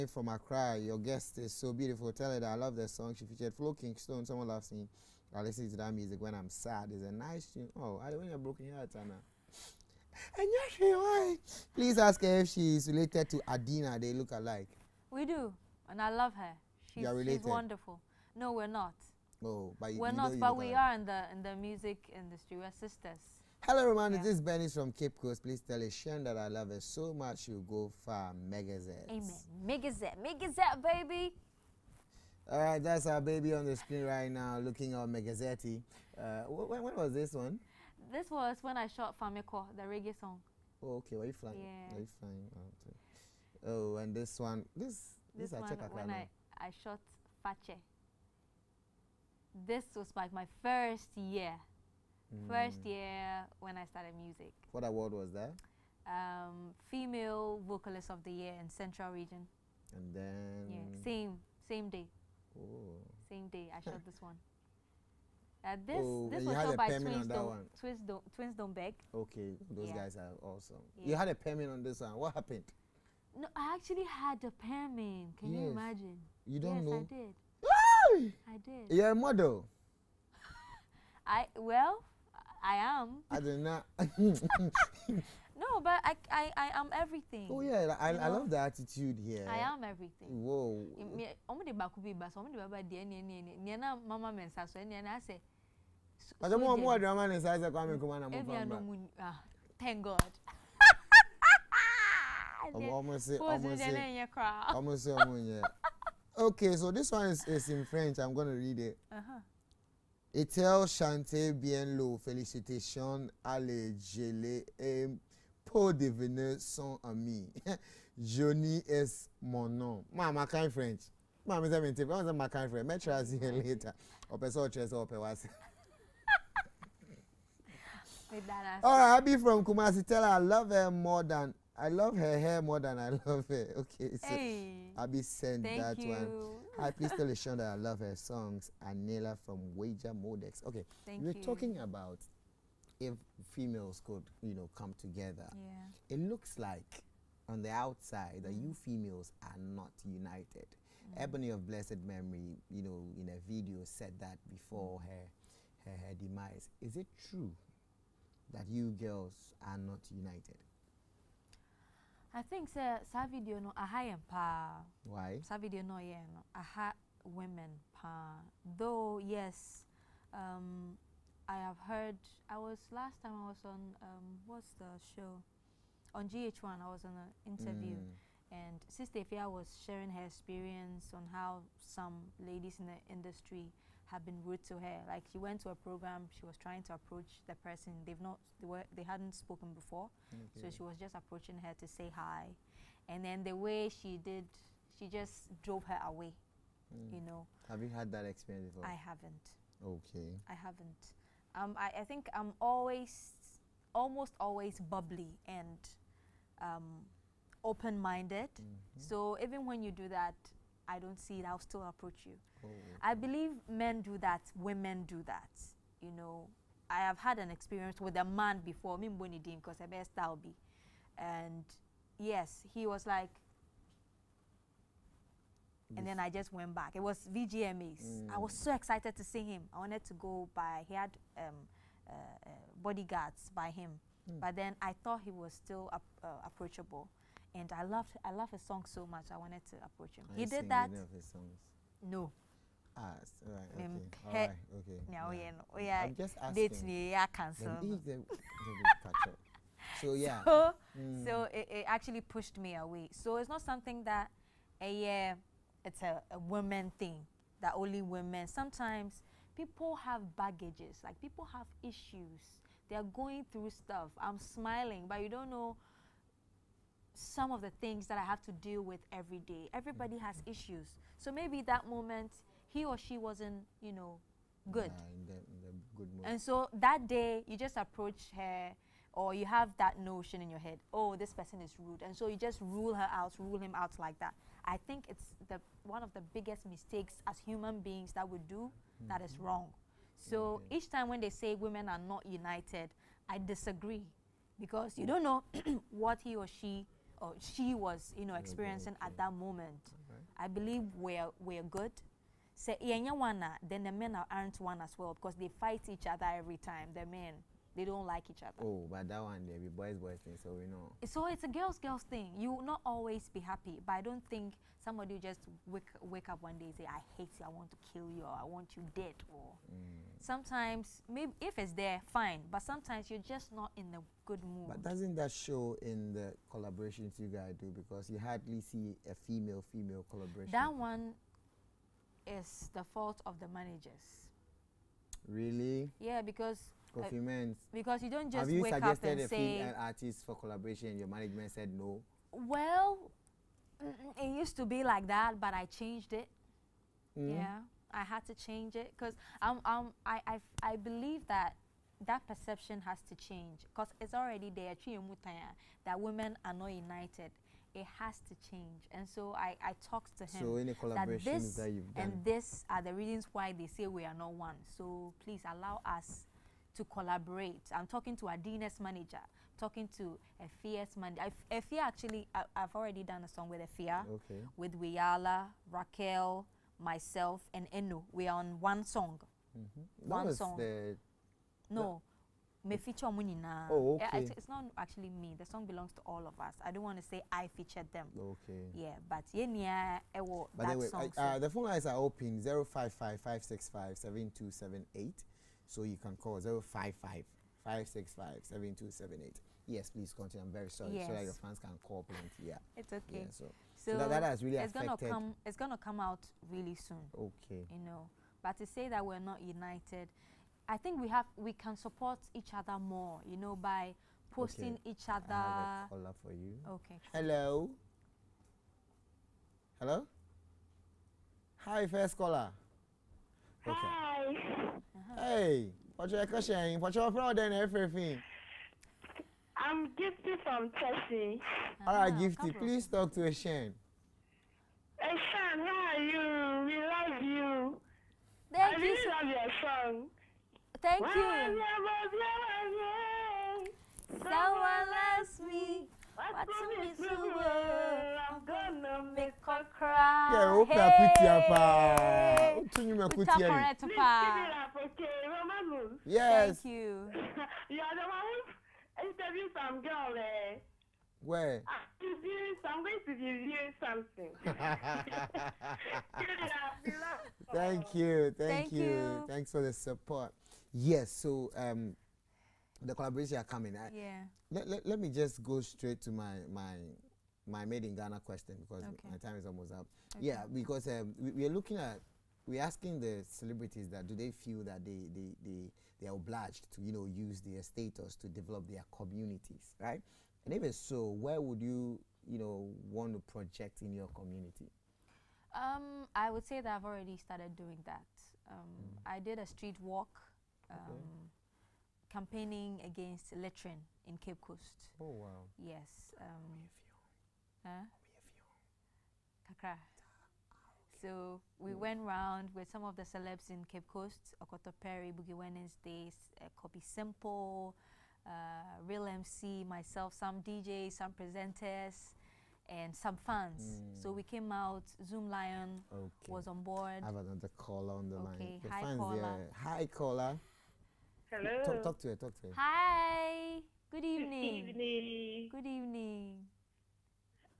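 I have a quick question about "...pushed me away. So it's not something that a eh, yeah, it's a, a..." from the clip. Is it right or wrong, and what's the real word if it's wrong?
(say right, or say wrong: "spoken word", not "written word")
right.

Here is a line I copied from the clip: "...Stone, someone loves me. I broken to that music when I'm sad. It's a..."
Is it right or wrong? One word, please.
wrong.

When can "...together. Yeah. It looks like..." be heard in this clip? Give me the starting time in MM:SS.
02:25.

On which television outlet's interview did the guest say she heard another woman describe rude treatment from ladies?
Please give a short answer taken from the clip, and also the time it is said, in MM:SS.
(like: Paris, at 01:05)
GH1, at 02:56.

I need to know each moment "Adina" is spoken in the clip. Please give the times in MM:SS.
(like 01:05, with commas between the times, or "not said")
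00:13, 06:08.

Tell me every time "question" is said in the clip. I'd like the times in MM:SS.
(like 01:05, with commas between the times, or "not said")
07:06, 07:58.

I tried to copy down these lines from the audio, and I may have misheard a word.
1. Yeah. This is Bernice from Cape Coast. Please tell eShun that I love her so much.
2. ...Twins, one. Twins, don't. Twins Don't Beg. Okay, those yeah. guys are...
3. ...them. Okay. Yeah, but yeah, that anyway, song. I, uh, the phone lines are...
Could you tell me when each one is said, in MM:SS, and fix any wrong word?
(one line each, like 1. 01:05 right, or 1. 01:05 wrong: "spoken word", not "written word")
1. 00:24 right
2. 01:06 right
3. 06:27 right.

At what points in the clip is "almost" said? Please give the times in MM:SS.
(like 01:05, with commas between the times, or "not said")
03:23, 07:59.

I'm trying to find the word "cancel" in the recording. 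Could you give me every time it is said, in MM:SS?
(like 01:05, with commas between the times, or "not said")
04:07.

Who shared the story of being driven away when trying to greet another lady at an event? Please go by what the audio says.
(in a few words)
Sister Fia.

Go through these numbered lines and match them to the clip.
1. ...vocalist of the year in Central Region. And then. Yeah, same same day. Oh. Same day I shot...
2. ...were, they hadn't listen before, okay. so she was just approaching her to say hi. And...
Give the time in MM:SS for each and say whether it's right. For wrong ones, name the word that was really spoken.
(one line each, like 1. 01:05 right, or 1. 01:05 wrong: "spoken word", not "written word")
1. 00:57 right
2. 03:08 wrong: "spoken", not "listen".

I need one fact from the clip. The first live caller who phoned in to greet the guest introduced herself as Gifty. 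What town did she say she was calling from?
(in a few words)
Tessie.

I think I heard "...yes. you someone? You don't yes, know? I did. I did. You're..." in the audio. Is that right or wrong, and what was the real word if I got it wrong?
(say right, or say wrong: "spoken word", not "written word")
wrong: "imagine", not "someone".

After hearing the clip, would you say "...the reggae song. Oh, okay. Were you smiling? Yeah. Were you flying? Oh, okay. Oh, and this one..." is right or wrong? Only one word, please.
wrong.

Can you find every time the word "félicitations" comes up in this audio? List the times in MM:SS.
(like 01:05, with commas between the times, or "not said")
01:52.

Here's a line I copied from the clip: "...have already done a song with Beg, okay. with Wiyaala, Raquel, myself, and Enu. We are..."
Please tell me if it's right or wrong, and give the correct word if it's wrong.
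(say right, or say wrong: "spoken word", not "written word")
wrong: "Fia", not "Beg".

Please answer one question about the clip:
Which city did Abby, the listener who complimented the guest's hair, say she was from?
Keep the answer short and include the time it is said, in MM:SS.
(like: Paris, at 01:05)
Kumasi, at 02:09.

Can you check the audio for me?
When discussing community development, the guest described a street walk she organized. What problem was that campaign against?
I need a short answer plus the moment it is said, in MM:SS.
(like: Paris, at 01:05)
Littering, at 08:23.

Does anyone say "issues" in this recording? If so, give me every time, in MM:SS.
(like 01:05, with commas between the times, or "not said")
04:21, 04:30.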